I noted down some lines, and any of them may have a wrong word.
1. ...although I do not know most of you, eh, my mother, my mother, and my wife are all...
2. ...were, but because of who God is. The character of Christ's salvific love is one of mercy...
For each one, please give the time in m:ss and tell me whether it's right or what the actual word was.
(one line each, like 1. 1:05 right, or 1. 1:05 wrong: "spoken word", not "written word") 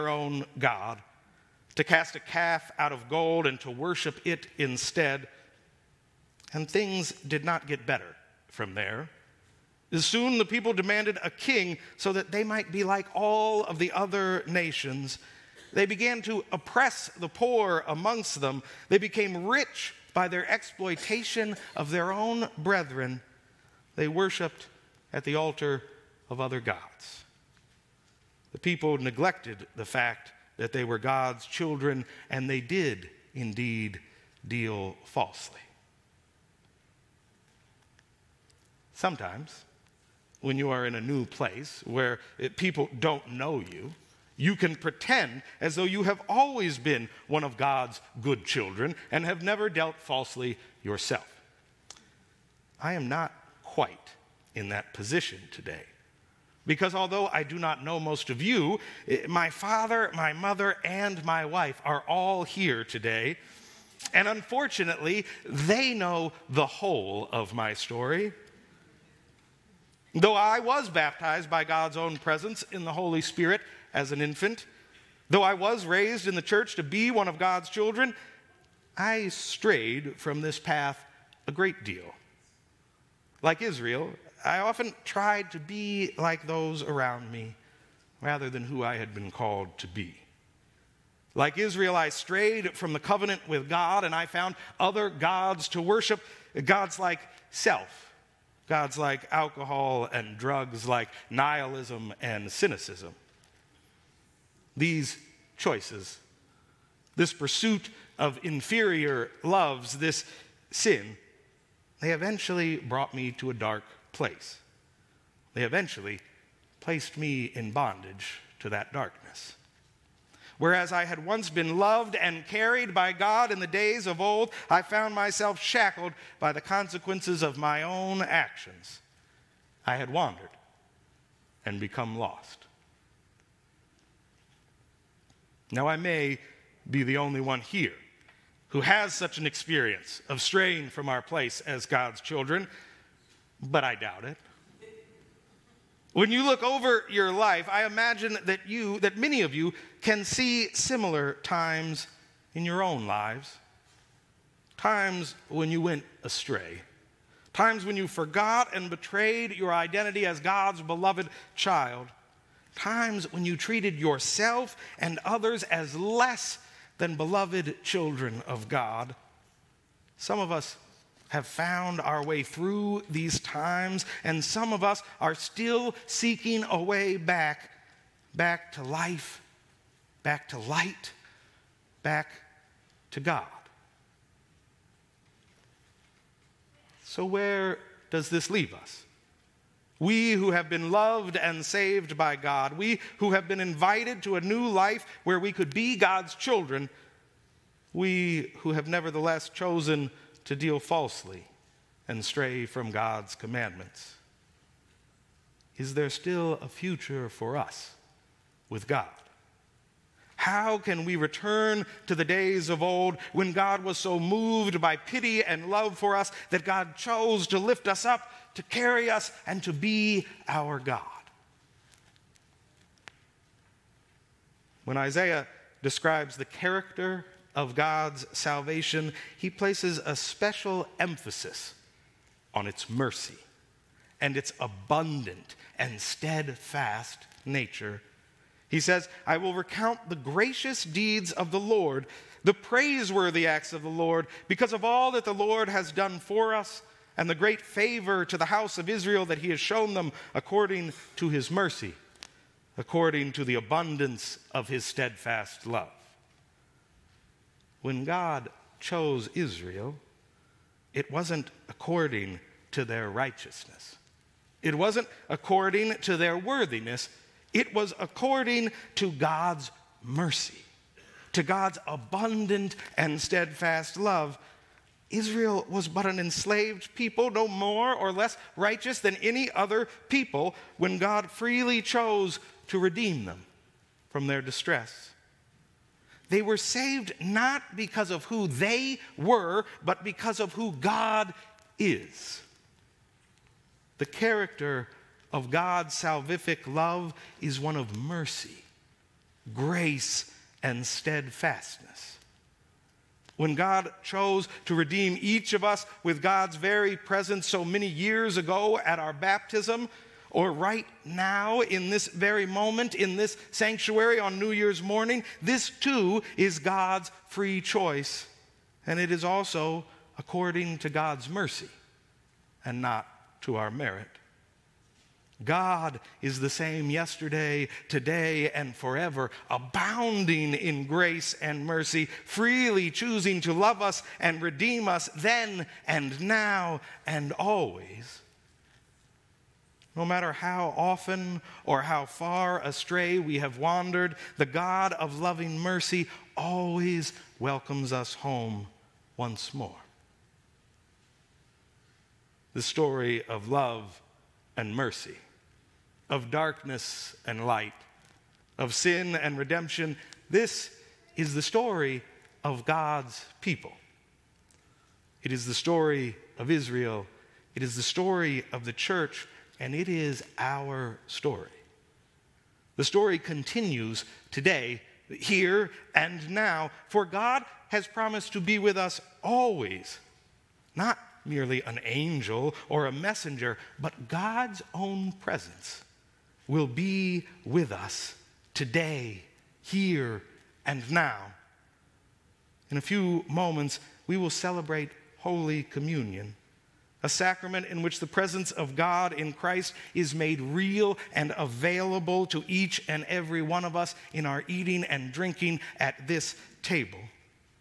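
1. 0:56 wrong: "father", not "mother"
2. 4:49 wrong: "God", not "Christ".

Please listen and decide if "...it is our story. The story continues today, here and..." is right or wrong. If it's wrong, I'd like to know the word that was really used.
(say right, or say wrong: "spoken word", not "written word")
right.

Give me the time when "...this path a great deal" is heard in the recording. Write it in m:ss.
1:20.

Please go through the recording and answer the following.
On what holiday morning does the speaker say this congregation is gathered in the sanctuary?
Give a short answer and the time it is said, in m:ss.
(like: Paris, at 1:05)
New Year's, at 5:14.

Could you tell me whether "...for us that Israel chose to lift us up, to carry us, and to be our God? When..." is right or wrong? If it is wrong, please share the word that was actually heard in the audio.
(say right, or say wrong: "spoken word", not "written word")
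wrong: "God", not "Israel".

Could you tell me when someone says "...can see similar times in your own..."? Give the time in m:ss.
2:30.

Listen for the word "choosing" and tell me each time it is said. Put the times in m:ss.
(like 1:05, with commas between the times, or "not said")
5:32.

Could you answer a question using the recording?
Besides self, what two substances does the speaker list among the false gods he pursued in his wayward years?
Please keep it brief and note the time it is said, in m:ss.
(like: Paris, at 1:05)
alcohol and drugs, at 1:39.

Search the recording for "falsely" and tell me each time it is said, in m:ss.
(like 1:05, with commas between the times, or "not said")
0:35, 0:49, 3:20.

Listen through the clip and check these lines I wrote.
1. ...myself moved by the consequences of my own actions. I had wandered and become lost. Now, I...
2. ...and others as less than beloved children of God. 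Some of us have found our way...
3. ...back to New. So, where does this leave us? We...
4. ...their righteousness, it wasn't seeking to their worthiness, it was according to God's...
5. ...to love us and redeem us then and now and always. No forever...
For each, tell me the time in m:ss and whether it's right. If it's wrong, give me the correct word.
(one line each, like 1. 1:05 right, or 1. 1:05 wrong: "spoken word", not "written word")
1. 2:05 wrong: "shackled", not "moved"
2. 2:44 right
3. 3:02 wrong: "God", not "New"
4. 4:22 wrong: "according", not "seeking"
5. 5:33 wrong: "matter", not "forever".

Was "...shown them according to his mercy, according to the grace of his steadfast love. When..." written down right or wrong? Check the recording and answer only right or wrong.
wrong.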